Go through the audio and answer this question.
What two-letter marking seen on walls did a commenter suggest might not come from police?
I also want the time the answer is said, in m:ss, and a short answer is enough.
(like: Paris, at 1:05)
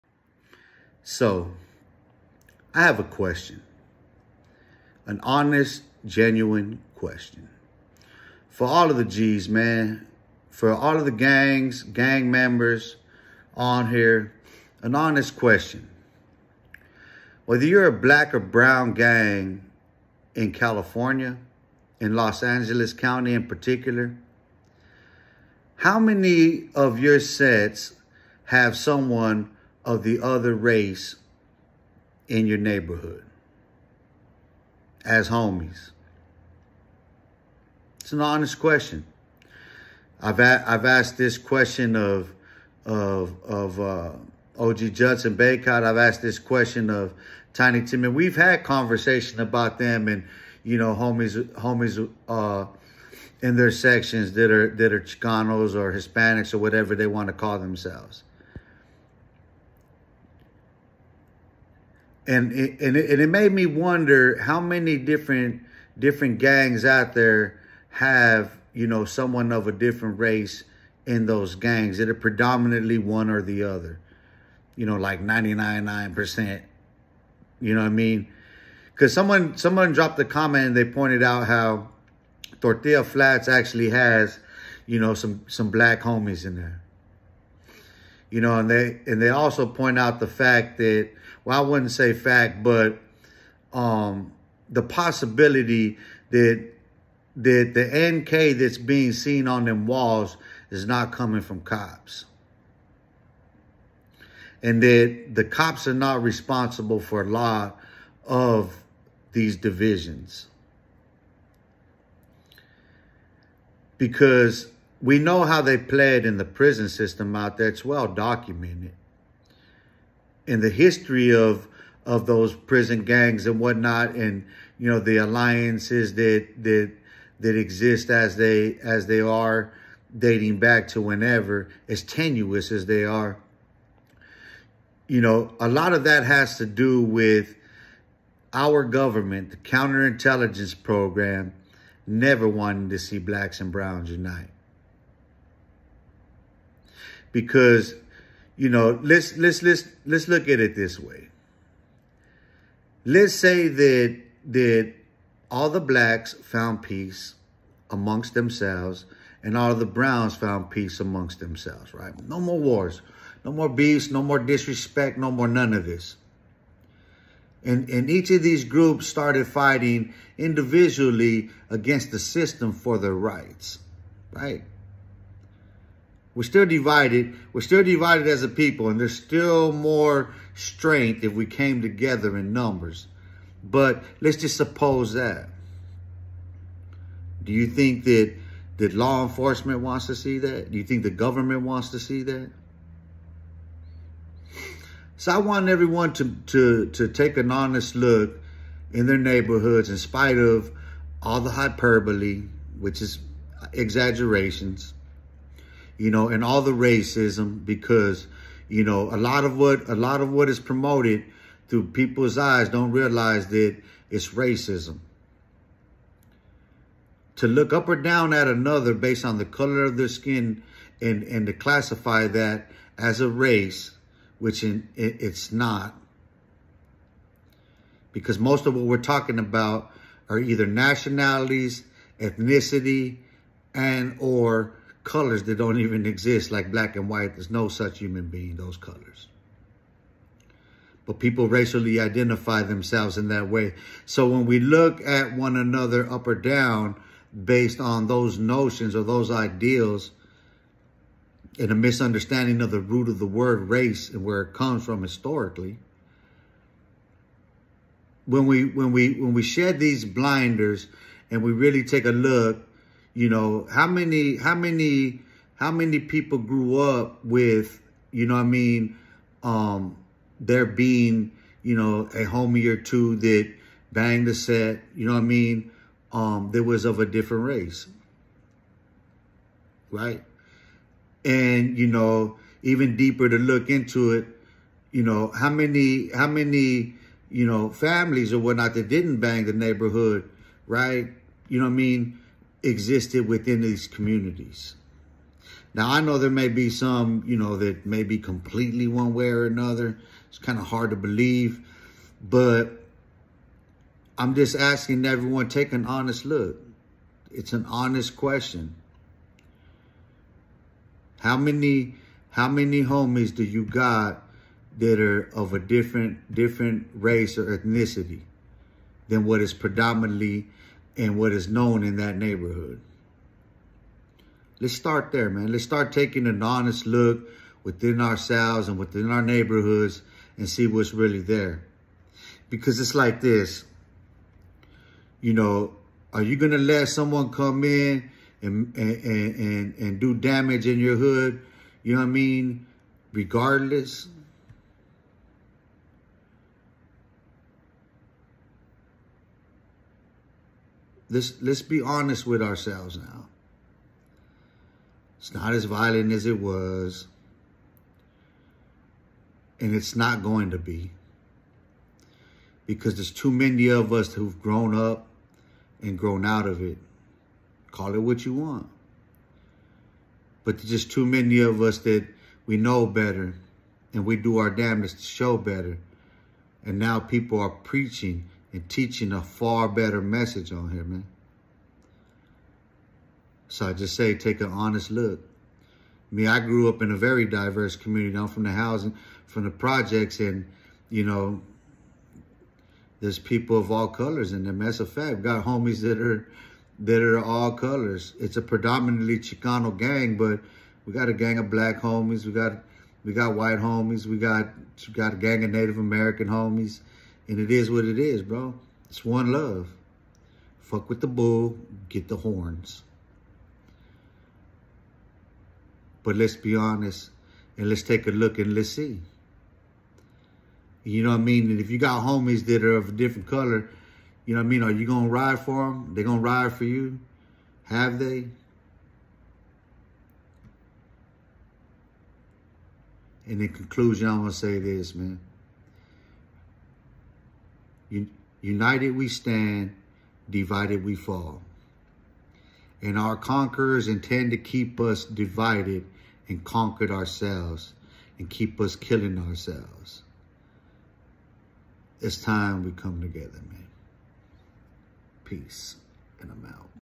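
NK, at 1:38.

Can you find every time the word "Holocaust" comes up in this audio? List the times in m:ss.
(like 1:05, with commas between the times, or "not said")
not said.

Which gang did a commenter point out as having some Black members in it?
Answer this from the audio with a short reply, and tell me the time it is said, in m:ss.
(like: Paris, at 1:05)
Tortilla Flats, at 1:22.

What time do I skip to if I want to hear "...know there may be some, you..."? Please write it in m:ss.
4:56.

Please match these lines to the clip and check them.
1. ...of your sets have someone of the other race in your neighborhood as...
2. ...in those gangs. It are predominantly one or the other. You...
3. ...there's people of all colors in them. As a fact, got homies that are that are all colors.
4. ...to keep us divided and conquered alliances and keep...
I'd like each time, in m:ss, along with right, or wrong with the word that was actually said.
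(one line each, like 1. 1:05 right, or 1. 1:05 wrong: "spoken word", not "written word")
1. 0:26 right
2. 1:11 right
3. 6:32 right
4. 7:24 wrong: "ourselves", not "alliances".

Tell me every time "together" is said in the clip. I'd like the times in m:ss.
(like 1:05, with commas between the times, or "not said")
3:01, 7:33.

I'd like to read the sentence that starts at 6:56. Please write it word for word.
But let's be honest and let's take a look and let's see.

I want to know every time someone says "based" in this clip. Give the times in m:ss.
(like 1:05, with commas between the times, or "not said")
3:38, 4:07.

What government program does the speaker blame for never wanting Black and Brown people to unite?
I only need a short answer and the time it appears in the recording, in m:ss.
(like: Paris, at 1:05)
counterintelligence program, at 2:19.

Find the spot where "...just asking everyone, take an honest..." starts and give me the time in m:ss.
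5:04.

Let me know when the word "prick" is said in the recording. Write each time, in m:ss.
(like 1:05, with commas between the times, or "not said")
not said.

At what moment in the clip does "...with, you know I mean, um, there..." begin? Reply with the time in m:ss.
4:27.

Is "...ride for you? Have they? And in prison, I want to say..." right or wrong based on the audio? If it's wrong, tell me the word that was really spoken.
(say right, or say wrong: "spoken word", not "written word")
wrong: "conclusion", not "prison".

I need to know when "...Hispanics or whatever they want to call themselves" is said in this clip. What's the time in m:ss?
0:55.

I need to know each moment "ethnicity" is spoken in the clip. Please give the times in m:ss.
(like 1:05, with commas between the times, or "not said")
3:52, 5:17.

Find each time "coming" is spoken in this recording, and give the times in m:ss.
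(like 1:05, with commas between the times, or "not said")
1:41.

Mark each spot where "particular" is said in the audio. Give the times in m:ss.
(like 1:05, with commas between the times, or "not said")
0:23.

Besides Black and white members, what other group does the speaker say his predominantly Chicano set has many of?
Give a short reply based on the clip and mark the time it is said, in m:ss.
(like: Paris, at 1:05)
Native American, at 6:45.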